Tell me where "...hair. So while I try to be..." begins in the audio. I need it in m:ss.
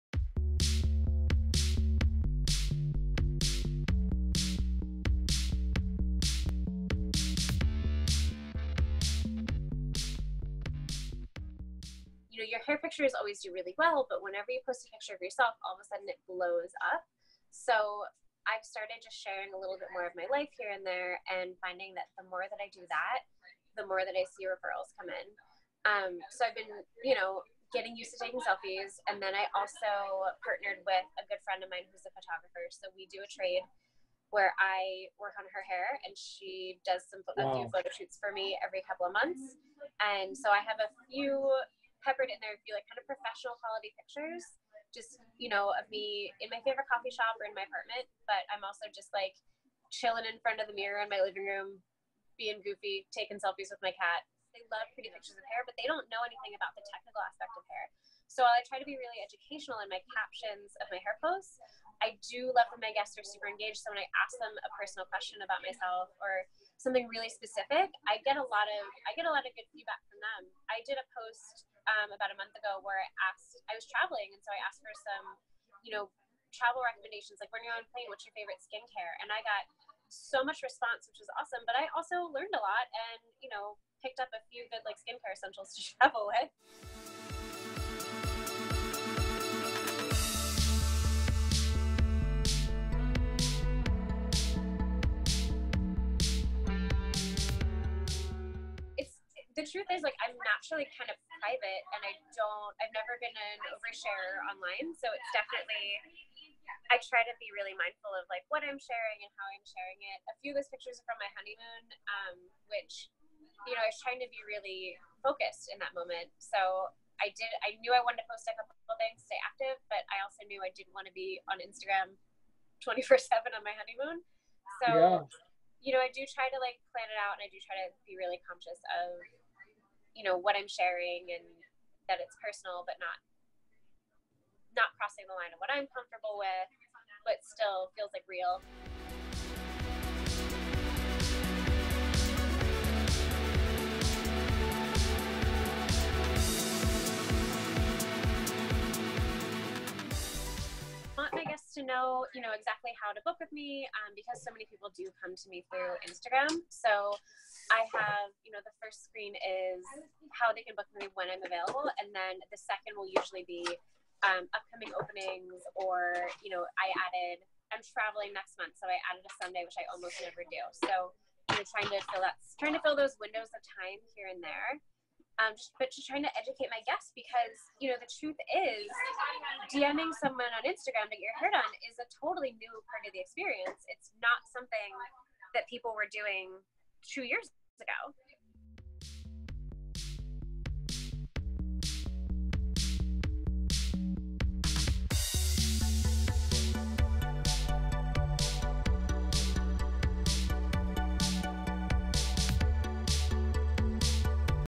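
0:57.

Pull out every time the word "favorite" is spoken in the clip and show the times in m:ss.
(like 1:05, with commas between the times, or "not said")
0:46, 1:18.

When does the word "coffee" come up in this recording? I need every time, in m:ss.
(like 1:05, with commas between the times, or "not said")
0:46.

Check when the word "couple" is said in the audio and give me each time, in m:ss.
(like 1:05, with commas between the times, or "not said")
0:38, 1:58.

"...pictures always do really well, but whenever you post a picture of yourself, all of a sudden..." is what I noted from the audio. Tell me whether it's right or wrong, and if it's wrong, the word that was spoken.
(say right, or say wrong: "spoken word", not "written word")
right.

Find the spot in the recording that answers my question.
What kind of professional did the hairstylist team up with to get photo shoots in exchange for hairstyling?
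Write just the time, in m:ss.
0:32.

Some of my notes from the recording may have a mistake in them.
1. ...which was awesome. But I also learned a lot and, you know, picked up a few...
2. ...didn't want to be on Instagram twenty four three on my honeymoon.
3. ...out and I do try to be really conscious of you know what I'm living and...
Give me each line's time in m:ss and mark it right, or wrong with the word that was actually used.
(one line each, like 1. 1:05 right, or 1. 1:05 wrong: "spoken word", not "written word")
1. 1:21 right
2. 2:00 wrong: "seven", not "three"
3. 2:07 wrong: "sharing", not "living".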